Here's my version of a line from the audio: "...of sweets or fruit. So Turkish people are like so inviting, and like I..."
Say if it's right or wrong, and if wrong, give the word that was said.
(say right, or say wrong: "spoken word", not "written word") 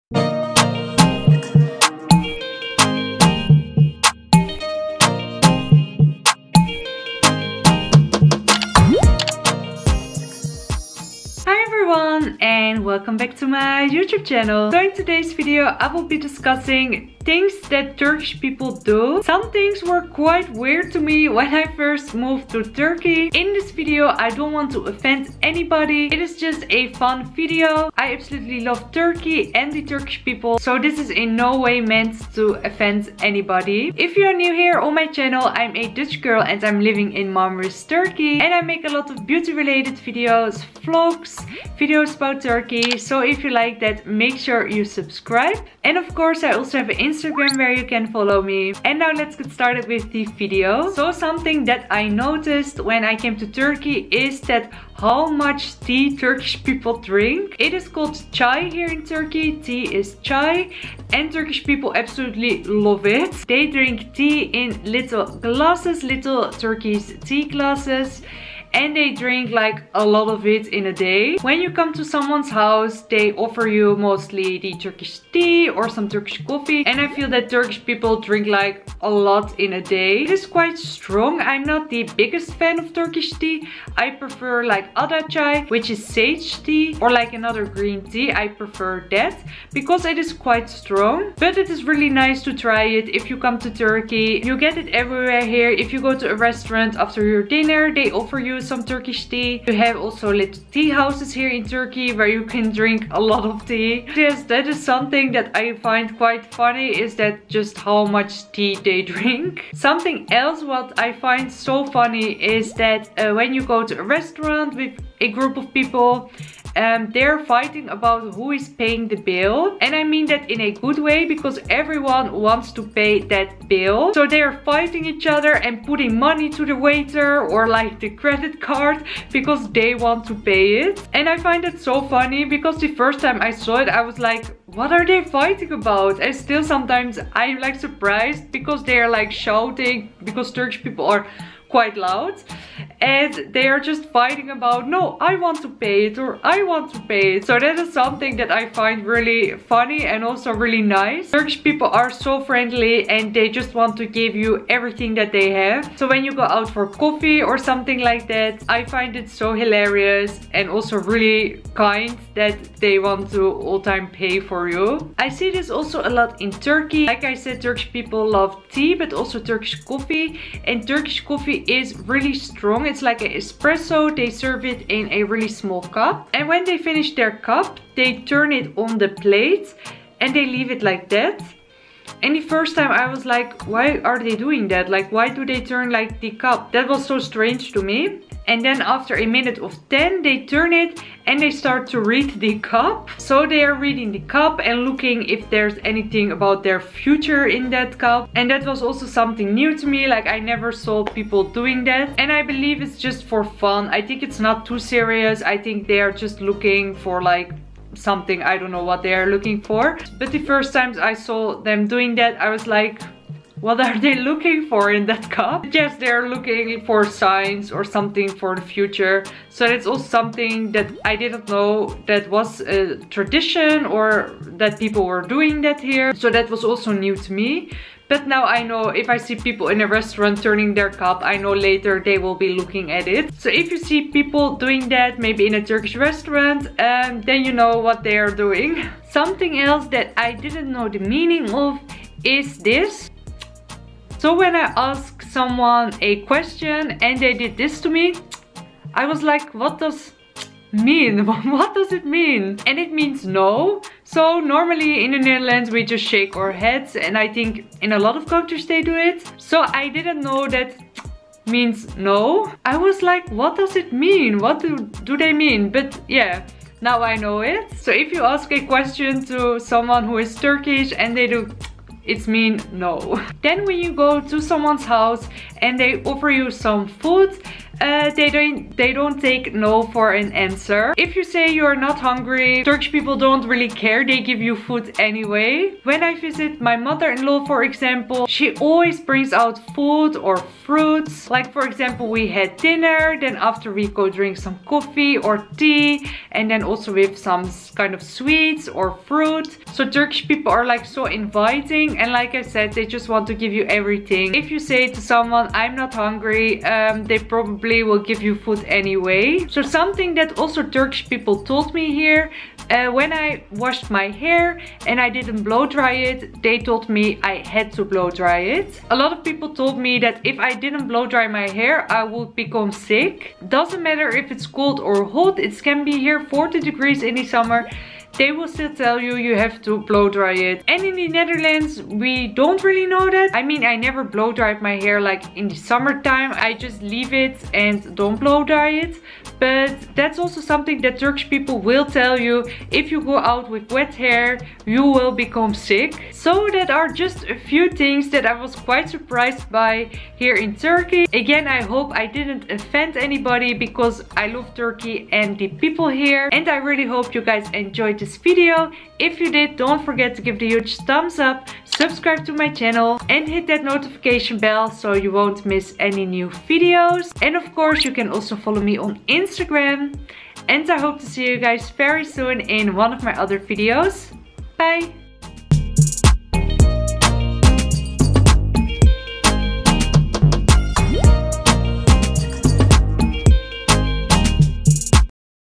right.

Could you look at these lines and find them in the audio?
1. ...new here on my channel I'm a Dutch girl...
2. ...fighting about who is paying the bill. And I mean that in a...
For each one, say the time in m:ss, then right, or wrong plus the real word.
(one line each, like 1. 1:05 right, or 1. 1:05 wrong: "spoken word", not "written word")
1. 0:34 right
2. 1:57 right.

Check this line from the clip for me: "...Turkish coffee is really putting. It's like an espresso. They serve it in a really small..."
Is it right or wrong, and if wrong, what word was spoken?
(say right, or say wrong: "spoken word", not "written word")
wrong: "strong", not "putting".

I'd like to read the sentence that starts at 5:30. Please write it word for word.
And in the Netherlands, we don't really know that.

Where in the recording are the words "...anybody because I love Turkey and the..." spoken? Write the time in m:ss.
5:52.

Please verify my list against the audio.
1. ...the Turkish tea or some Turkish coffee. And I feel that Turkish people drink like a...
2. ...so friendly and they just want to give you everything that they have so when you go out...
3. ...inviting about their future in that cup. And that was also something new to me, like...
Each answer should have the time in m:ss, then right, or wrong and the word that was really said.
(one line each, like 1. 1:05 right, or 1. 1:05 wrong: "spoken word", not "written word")
1. 1:14 right
2. 2:32 right
3. 3:15 wrong: "anything", not "inviting".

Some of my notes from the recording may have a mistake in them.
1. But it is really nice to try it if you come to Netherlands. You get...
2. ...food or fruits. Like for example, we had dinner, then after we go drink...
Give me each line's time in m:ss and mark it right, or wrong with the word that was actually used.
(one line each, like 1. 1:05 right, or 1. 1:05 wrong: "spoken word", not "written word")
1. 1:31 wrong: "Turkey", not "Netherlands"
2. 4:49 right.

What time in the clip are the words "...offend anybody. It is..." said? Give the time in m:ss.
0:24.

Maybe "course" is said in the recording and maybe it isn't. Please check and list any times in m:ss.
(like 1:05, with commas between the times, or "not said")
0:46, 6:07.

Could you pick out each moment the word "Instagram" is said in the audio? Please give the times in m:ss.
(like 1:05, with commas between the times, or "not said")
0:46, 6:09.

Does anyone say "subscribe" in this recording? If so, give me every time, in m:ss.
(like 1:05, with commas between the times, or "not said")
0:44, 6:01.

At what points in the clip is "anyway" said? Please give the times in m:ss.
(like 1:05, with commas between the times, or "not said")
4:44, 5:08.